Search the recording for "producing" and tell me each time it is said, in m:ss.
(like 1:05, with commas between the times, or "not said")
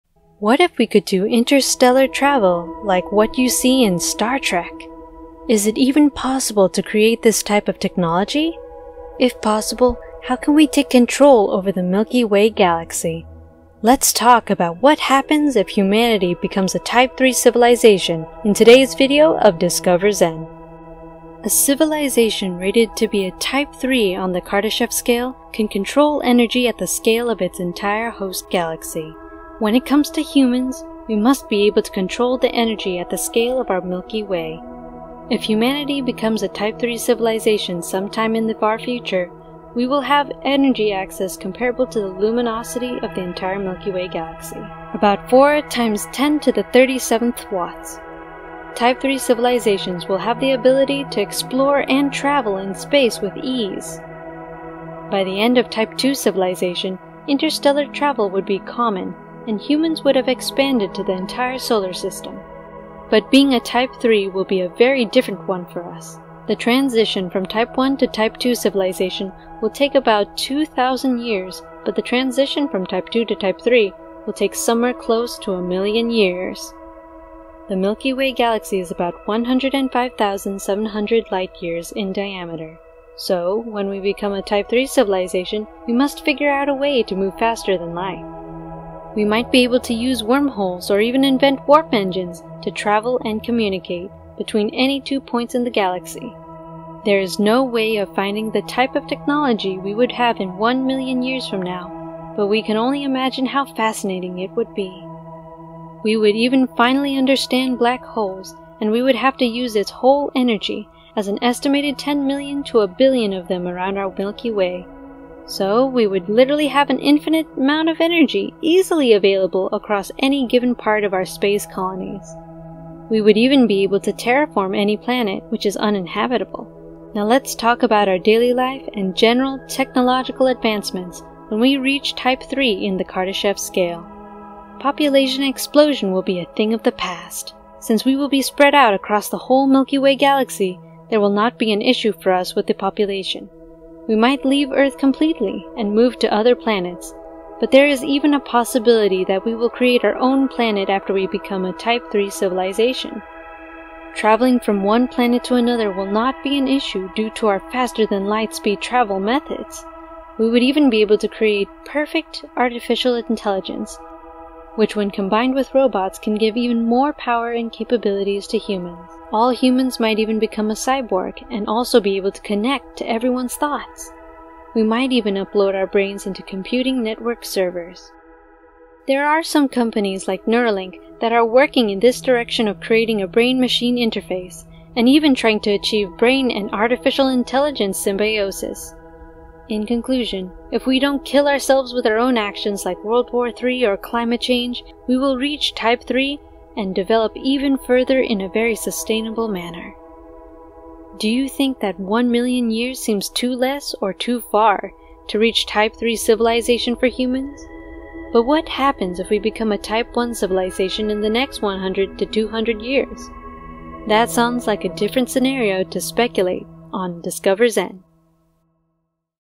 not said.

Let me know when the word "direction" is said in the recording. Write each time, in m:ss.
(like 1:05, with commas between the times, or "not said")
3:02.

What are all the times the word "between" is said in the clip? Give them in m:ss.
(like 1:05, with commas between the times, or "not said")
1:34.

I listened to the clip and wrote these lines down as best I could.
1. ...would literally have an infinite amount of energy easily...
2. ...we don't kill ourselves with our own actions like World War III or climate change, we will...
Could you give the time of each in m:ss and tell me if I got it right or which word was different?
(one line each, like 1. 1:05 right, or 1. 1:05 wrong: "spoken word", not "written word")
1. 1:56 right
2. 3:10 right.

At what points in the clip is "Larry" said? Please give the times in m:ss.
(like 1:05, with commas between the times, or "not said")
not said.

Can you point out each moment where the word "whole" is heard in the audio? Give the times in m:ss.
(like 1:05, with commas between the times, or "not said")
1:49, 2:19.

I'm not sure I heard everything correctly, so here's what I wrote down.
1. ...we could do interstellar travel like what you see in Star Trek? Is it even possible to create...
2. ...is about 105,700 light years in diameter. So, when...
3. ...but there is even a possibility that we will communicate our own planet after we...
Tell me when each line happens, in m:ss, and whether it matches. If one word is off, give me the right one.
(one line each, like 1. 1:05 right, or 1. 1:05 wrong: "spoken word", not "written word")
1. 0:00 right
2. 1:18 right
3. 2:27 wrong: "create", not "communicate".